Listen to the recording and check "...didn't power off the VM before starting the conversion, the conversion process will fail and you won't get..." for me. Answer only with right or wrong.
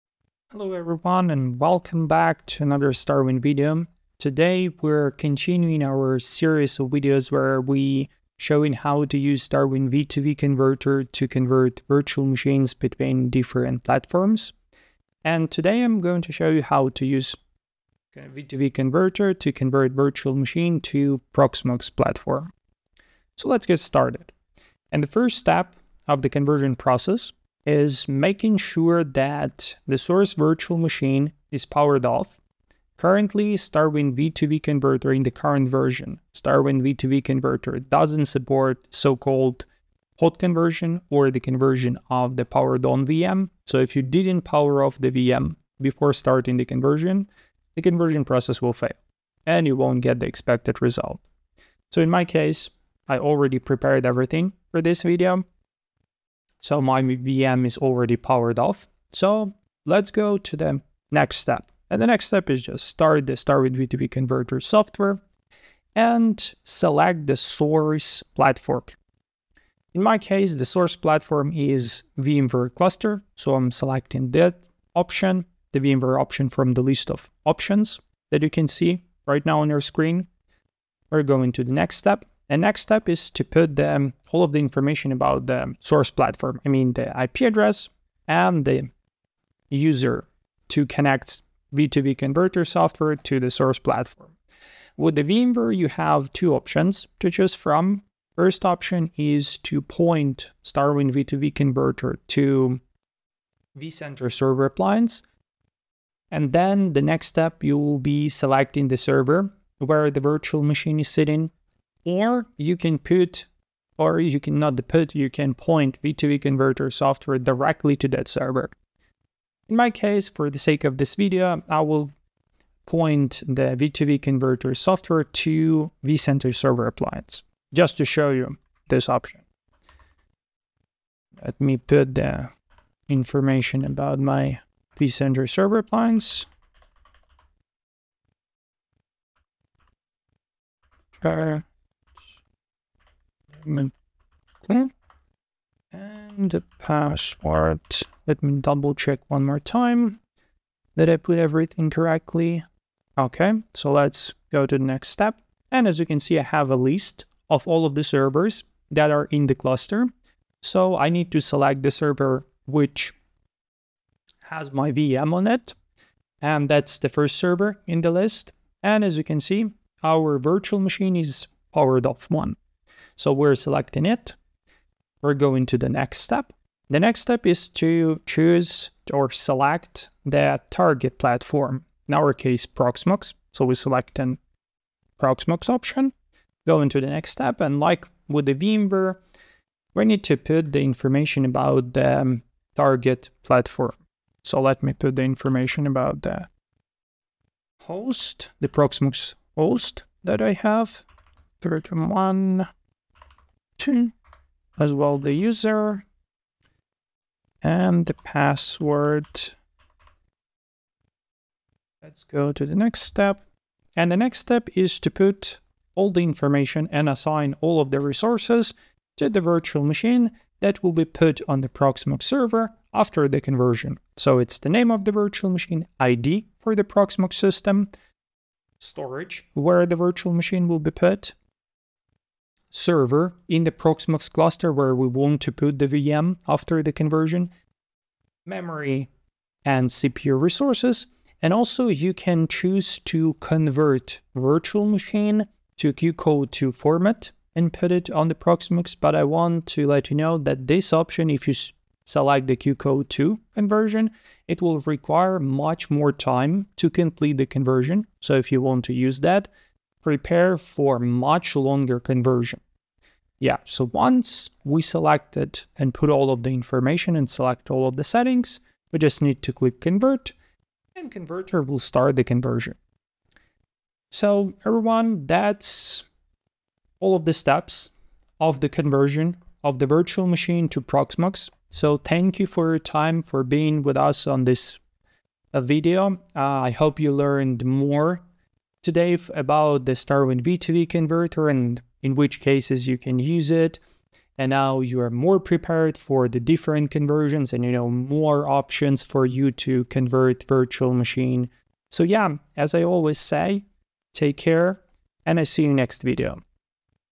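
right.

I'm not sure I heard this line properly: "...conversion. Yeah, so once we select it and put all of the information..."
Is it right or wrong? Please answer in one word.
right.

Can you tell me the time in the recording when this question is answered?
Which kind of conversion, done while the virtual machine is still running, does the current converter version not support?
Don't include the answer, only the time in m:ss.
0:40.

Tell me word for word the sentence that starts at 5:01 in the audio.
So yeah, as I always say, take care and I see you next video.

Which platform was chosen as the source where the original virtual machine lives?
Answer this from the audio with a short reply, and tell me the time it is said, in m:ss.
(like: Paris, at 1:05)
VMware cluster, at 1:12.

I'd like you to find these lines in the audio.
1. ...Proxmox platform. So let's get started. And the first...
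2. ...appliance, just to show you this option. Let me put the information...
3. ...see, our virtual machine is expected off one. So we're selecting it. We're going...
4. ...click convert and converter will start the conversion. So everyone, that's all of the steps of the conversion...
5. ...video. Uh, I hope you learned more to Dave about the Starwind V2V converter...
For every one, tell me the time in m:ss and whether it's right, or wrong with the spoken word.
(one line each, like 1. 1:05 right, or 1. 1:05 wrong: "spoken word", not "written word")
1. 0:21 right
2. 2:06 right
3. 2:49 wrong: "powered", not "expected"
4. 4:29 right
5. 4:45 right.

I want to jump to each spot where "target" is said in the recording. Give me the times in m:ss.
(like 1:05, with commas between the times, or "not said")
3:00, 3:12.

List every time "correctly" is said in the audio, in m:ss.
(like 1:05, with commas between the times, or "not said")
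2:31.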